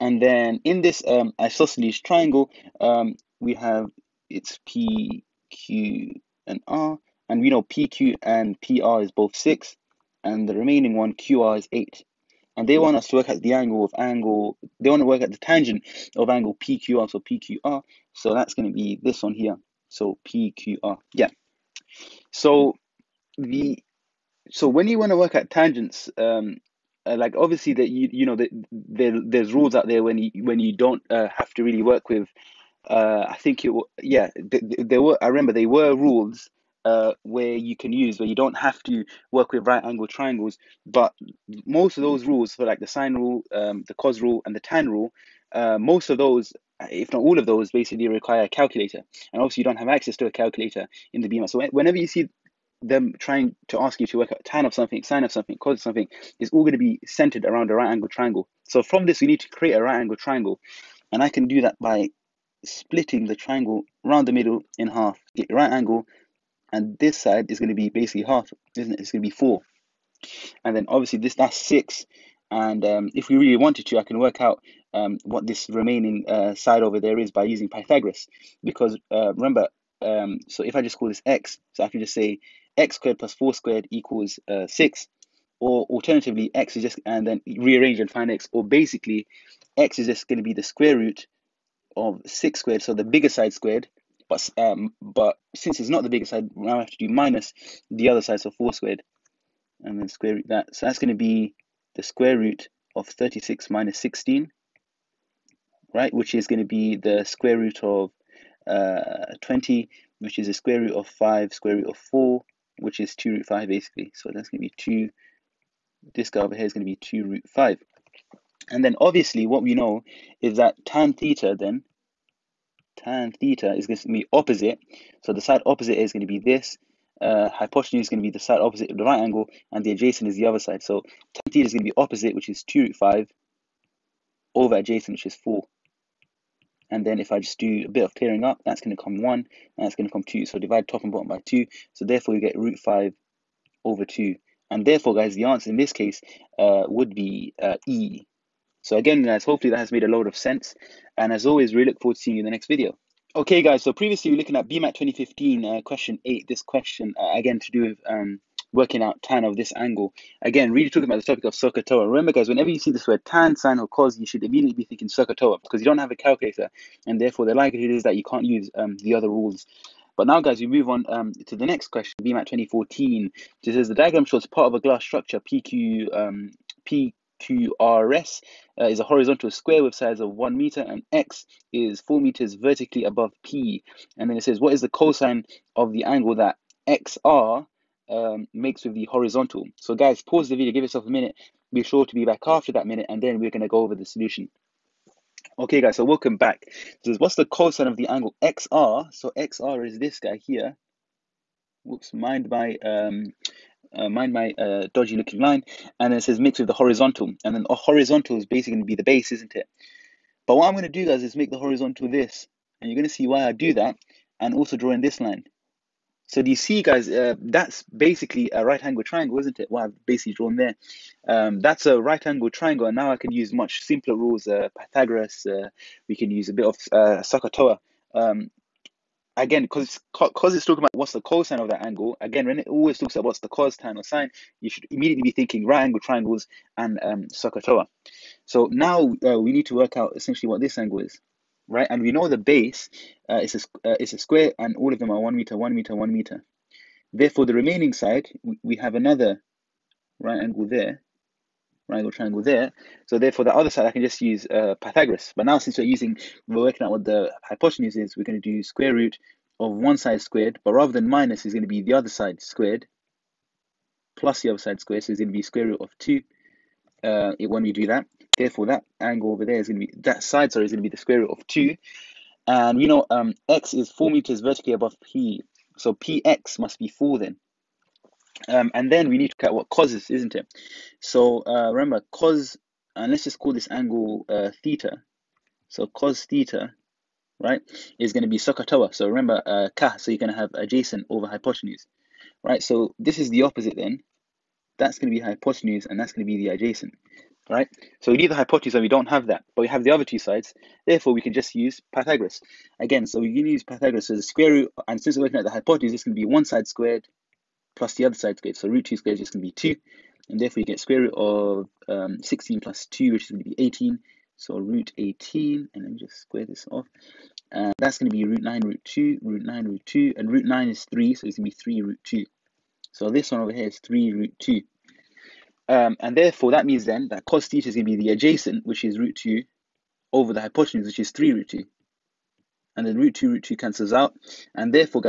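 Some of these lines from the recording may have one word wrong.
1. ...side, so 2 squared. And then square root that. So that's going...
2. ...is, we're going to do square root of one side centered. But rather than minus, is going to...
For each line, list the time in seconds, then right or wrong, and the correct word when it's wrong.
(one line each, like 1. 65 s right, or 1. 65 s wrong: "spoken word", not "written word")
1. 98 s wrong: "4", not "2"
2. 257 s wrong: "squared", not "centered".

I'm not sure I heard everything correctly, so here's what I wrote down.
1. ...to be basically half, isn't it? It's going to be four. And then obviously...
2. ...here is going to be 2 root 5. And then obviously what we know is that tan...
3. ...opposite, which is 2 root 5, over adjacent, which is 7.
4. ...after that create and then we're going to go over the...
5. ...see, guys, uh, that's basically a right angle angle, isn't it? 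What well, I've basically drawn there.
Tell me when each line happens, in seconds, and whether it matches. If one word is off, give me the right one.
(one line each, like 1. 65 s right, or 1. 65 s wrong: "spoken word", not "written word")
1. 67 s right
2. 116 s right
3. 131 s wrong: "4", not "7"
4. 192 s wrong: "minute", not "create"
5. 216 s wrong: "triangle", not "angle".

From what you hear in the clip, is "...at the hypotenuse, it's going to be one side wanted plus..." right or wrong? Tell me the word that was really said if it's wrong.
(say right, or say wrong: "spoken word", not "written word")
wrong: "squared", not "wanted".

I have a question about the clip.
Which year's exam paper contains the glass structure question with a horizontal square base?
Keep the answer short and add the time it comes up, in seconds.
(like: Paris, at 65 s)
2014, at 172 s.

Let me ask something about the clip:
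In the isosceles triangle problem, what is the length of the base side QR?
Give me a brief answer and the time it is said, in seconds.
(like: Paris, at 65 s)
8, at 11 s.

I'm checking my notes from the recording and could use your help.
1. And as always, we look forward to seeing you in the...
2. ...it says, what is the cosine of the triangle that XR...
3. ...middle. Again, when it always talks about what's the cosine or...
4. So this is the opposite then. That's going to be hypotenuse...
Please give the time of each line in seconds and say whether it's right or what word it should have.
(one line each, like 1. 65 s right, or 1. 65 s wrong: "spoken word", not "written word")
1. 151 s right
2. 184 s wrong: "angle", not "triangle"
3. 231 s wrong: "angle", not "middle"
4. 292 s right.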